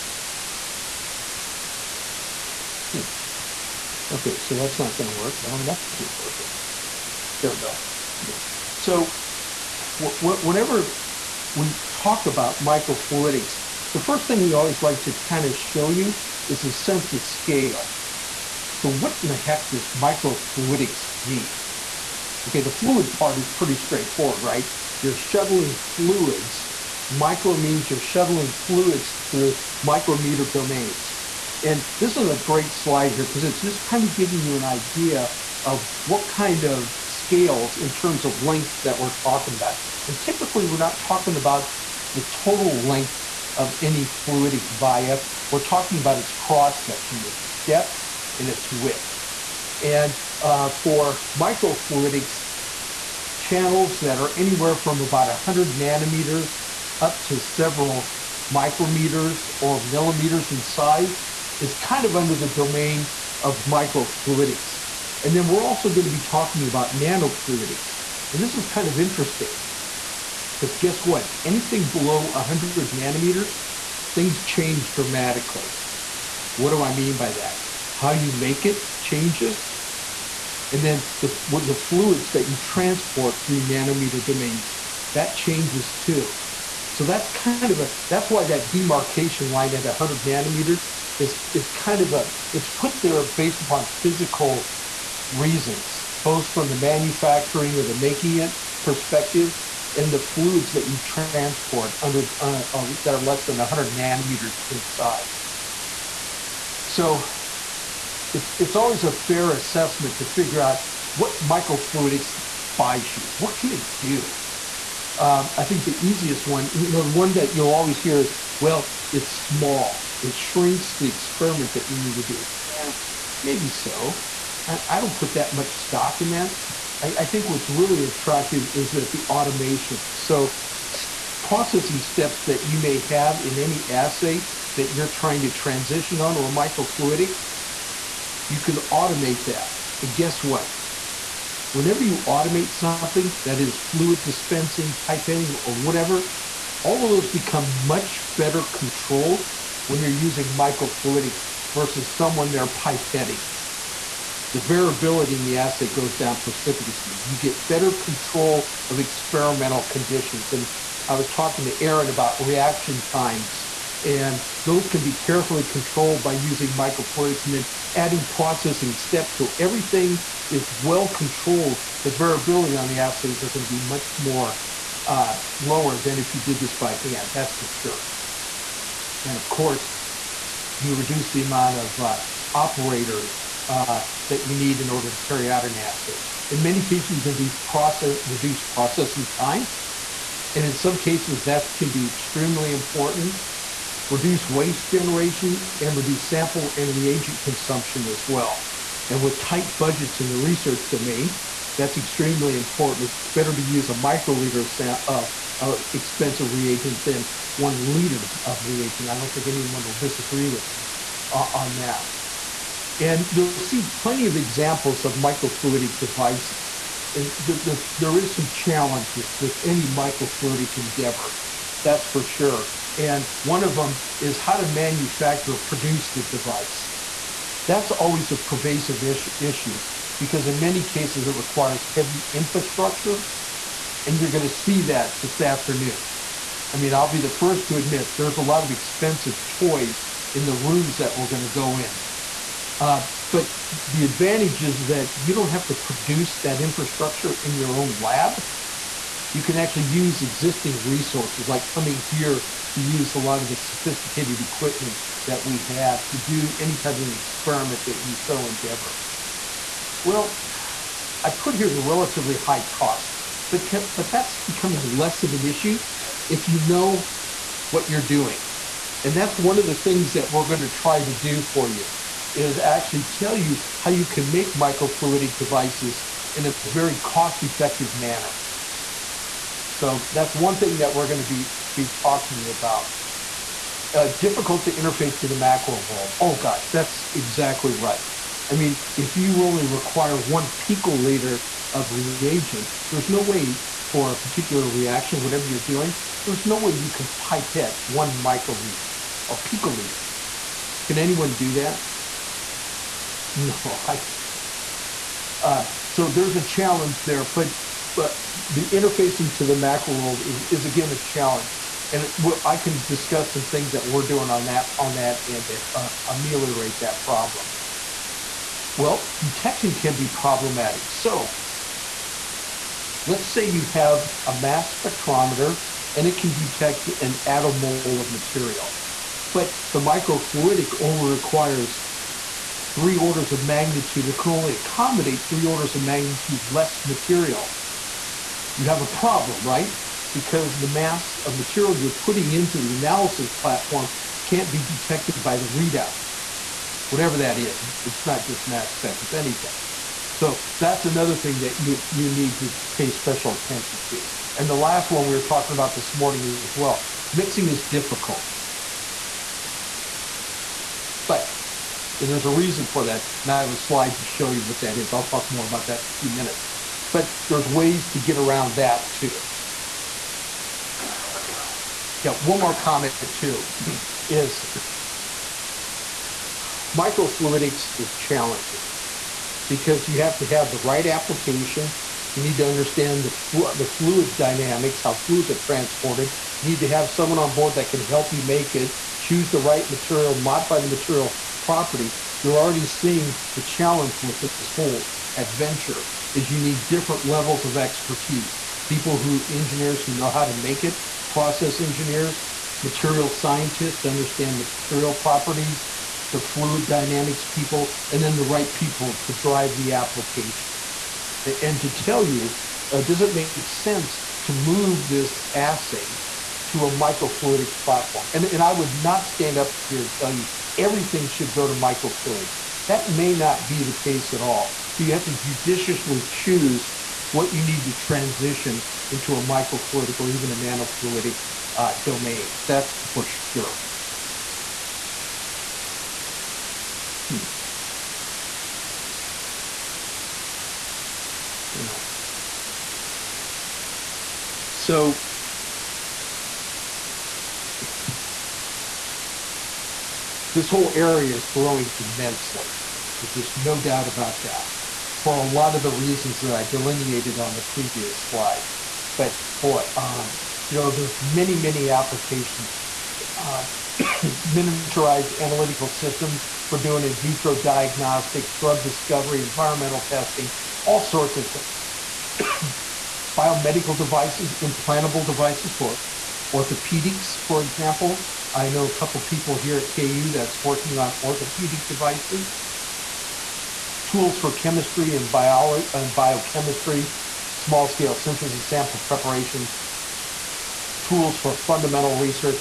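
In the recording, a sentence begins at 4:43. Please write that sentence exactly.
Uh, difficult to interface to the macro world.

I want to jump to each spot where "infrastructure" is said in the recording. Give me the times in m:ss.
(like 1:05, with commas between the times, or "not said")
3:52, 4:06.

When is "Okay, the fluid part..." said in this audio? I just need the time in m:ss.
0:22.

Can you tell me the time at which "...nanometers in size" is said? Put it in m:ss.
1:43.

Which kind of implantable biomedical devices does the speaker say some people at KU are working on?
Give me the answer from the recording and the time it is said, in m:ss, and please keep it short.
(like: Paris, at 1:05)
orthopedic devices, at 8:01.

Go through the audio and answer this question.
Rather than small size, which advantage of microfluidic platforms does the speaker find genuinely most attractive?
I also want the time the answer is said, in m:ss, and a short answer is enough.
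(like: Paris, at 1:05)
automation, at 2:09.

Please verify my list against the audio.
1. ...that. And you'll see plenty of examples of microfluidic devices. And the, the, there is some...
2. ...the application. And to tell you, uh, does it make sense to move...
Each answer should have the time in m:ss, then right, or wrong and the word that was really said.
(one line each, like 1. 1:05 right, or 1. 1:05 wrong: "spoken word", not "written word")
1. 3:31 right
2. 6:49 right.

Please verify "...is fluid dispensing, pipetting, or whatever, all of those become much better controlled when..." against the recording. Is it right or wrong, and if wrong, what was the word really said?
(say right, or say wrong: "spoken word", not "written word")
right.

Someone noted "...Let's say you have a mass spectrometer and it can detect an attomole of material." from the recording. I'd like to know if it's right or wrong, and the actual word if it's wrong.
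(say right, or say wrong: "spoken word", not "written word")
right.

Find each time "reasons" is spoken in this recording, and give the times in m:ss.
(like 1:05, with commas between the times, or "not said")
1:35, 6:02, 7:35.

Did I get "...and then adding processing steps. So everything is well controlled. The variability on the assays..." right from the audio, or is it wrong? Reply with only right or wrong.
right.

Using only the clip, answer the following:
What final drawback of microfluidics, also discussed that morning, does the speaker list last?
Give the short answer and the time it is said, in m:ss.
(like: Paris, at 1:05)
mixing, at 5:57.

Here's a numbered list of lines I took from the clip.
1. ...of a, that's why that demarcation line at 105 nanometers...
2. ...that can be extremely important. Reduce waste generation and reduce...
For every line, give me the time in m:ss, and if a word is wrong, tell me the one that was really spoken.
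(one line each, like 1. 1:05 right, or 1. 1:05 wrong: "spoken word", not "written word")
1. 1:27 wrong: "100", not "105"
2. 3:11 right.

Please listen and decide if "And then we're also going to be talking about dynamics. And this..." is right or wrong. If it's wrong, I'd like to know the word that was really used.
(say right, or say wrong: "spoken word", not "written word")
wrong: "nanofluidics", not "dynamics".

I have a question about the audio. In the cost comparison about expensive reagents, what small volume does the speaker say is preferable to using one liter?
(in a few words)
a microliter.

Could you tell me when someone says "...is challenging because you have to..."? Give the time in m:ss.
6:17.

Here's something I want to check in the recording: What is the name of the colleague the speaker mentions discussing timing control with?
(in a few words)
Aaron.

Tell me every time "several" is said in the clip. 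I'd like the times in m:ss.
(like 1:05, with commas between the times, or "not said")
0:57.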